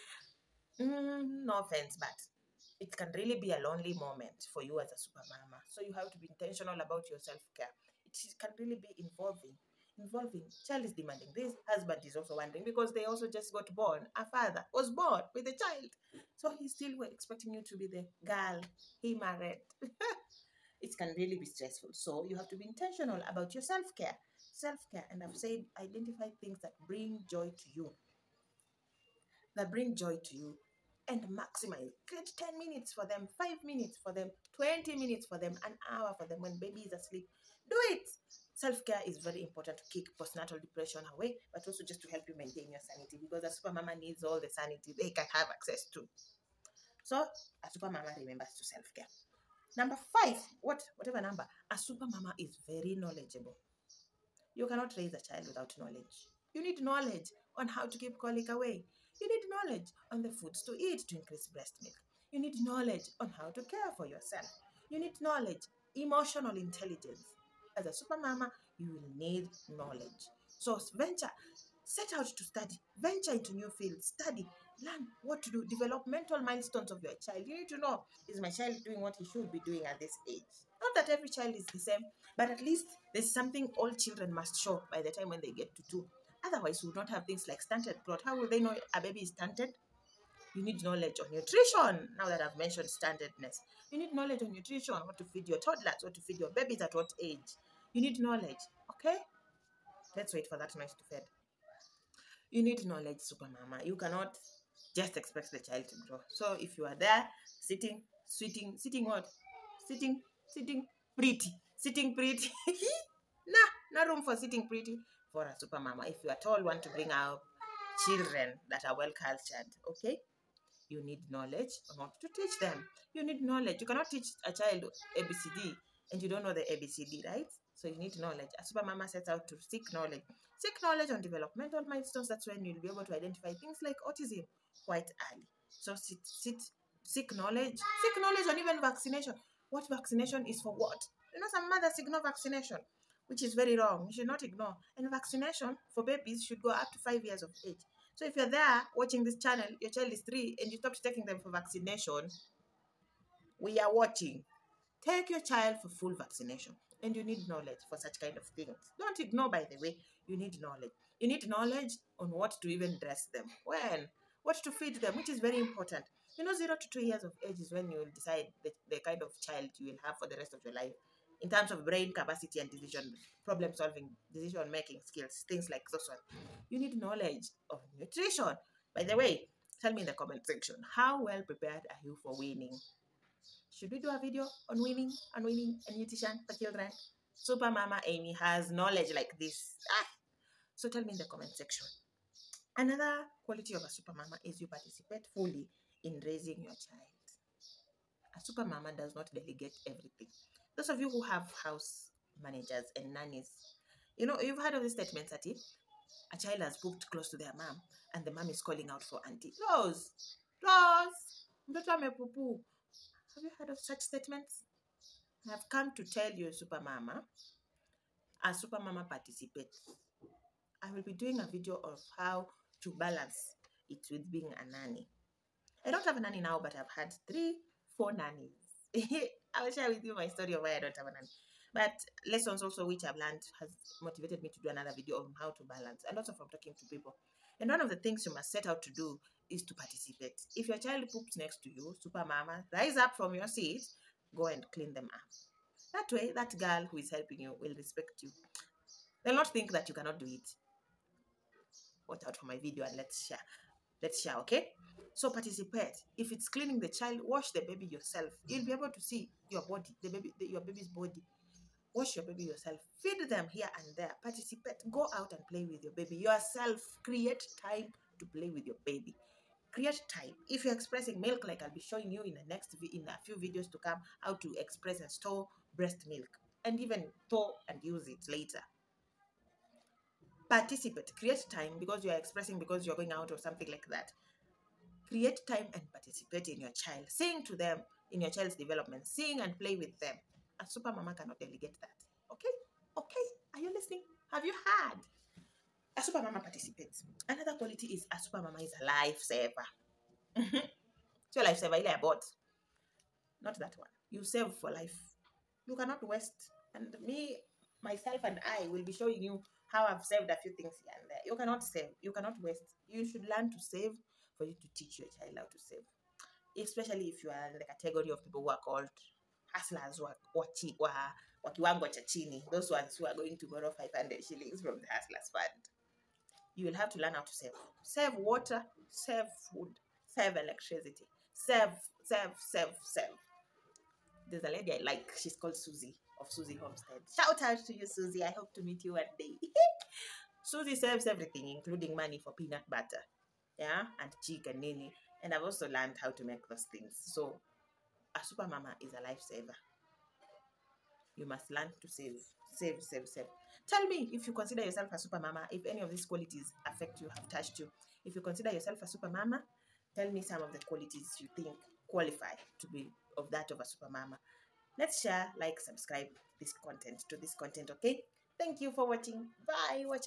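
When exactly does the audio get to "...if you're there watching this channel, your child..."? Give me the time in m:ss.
2:28.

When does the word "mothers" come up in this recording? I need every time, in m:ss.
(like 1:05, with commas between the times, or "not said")
2:21.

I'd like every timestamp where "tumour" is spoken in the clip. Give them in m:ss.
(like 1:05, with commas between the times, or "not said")
not said.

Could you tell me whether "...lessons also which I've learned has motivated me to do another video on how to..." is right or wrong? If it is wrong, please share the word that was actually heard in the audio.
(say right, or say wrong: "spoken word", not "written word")
right.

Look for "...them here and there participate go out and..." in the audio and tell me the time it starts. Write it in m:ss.
4:23.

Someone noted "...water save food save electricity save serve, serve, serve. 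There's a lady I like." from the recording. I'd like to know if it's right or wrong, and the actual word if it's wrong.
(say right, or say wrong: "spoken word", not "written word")
right.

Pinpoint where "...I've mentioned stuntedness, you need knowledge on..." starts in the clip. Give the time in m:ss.
1:32.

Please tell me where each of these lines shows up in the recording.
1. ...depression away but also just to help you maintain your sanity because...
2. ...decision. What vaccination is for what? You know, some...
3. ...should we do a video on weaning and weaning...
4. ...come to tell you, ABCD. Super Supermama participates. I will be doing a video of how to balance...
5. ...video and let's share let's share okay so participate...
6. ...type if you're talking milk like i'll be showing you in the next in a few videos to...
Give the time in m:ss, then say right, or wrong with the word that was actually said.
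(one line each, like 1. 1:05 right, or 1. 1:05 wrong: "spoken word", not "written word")
1. 0:40 right
2. 2:18 wrong: "vaccination", not "decision"
3. 3:03 right
4. 3:35 wrong: "Supermama", not "ABCD"
5. 4:12 right
6. 4:30 wrong: "expressing", not "talking".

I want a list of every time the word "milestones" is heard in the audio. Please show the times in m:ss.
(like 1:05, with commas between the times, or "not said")
1:16, 2:11.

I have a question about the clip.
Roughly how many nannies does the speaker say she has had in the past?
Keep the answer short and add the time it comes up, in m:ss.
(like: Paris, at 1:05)
3 or 4, at 3:47.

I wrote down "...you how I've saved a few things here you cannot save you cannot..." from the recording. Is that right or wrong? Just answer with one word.
right.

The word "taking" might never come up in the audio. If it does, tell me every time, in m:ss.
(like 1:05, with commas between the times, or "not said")
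2:31.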